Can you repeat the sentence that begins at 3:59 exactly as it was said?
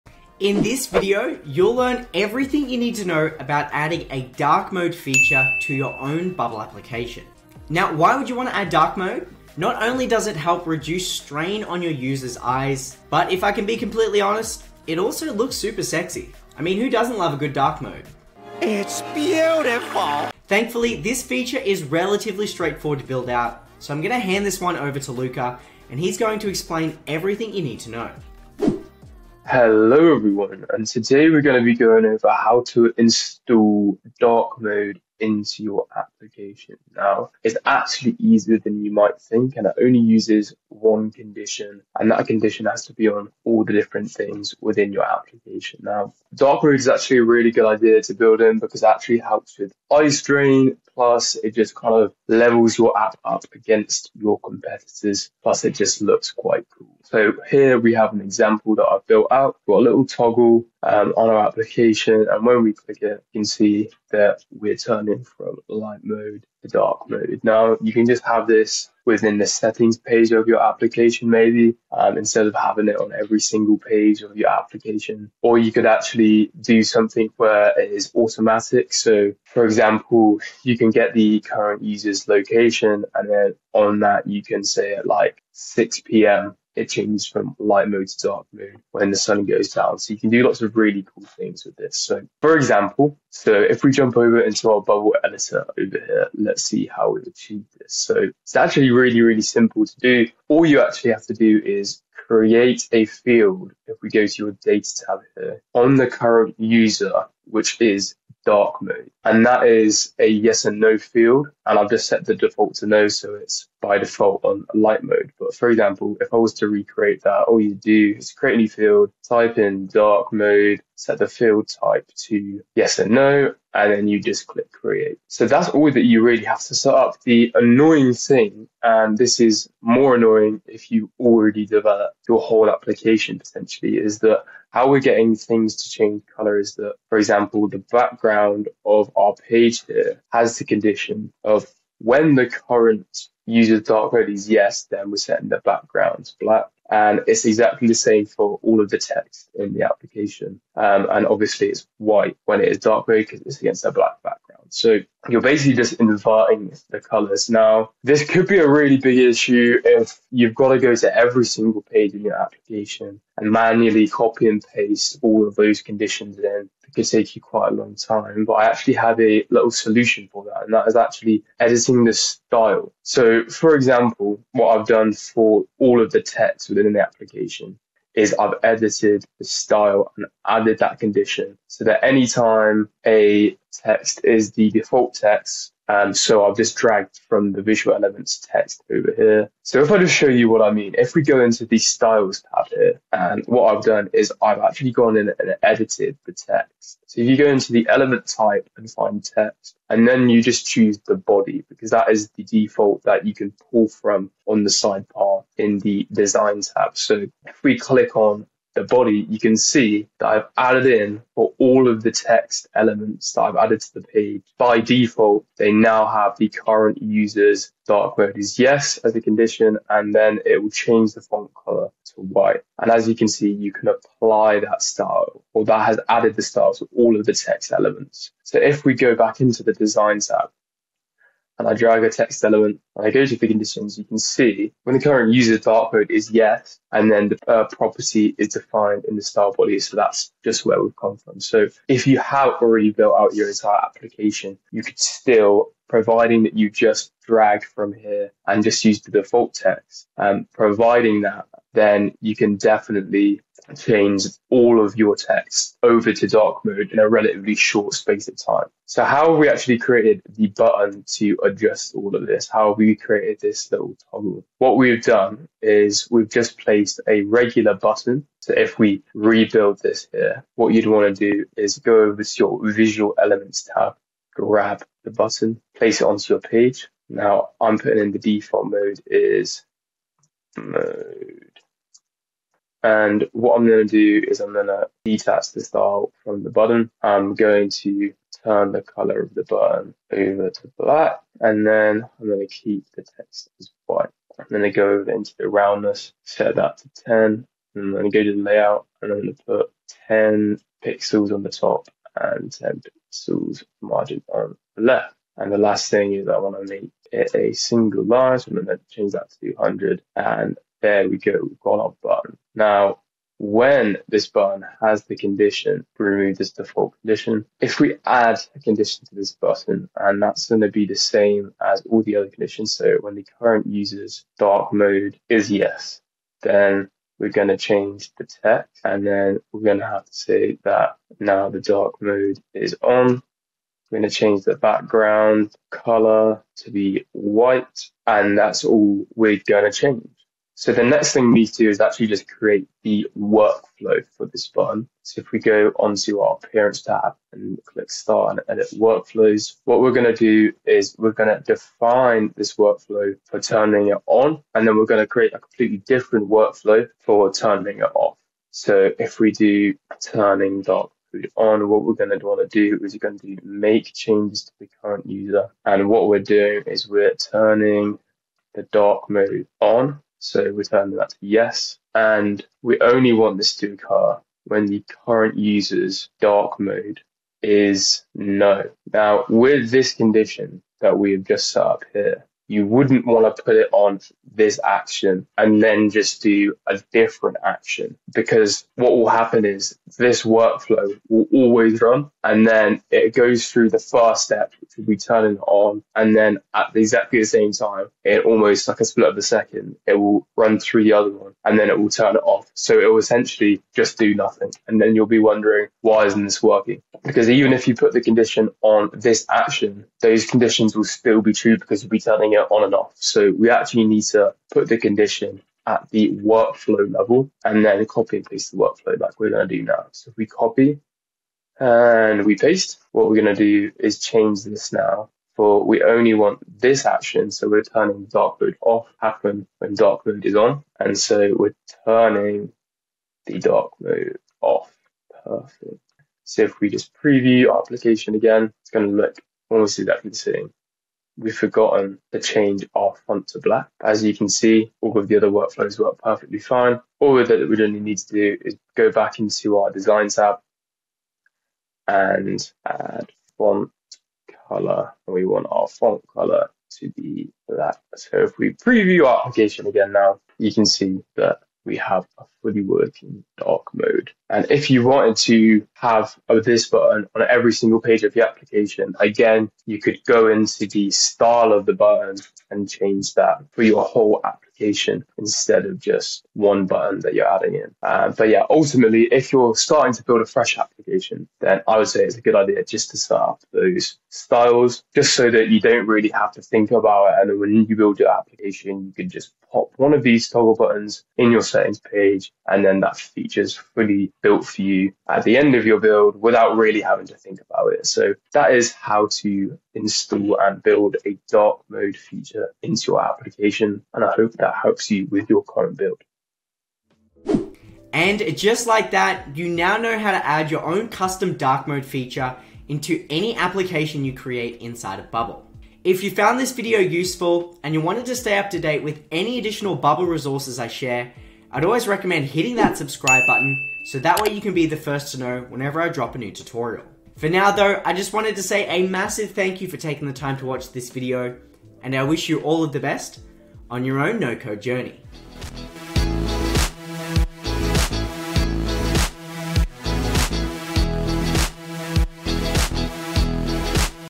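So that's just where we've come from.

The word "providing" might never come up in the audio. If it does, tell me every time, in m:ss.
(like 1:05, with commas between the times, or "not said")
4:05, 4:10.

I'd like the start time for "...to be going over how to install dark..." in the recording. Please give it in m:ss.
0:31.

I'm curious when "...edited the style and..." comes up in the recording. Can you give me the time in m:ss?
2:58.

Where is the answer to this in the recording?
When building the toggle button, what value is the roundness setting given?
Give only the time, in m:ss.
4:56.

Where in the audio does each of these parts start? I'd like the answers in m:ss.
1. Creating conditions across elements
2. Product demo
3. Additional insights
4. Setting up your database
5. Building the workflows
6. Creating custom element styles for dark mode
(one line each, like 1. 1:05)
1. 2:05
2. 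0:28
3. 8:27
4. 1:33
5. 5:40
6. 2:48.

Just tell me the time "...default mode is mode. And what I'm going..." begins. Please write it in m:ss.
4:38.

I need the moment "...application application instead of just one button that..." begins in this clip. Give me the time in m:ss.
7:54.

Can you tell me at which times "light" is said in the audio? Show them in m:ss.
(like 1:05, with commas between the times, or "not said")
1:05, 1:27, 1:54.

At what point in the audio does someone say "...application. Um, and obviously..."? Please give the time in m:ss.
2:29.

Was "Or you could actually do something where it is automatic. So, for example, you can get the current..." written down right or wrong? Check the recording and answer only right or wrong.
right.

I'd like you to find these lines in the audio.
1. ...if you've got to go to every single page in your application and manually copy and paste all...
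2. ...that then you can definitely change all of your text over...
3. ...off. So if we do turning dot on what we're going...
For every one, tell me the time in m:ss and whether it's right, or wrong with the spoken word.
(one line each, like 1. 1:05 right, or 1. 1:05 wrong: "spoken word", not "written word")
1. 2:39 right
2. 4:11 right
3. 5:57 right.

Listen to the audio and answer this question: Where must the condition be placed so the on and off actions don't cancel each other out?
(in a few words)
workflow level.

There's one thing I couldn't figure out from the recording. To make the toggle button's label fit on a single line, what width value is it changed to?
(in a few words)
200.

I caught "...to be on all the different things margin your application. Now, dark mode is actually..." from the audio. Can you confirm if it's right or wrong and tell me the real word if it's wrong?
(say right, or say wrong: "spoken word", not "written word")
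wrong: "within", not "margin".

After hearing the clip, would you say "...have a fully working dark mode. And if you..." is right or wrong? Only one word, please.
right.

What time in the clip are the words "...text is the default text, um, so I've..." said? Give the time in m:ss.
3:03.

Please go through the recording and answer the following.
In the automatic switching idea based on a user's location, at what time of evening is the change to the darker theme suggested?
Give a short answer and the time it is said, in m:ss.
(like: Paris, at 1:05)
6 p.m., at 1:25.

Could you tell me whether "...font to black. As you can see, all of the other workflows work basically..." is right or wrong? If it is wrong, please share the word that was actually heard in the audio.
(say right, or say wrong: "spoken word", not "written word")
wrong: "perfectly", not "basically".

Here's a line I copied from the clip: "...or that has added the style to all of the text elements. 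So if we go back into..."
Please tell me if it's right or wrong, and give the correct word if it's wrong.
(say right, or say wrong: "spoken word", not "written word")
right.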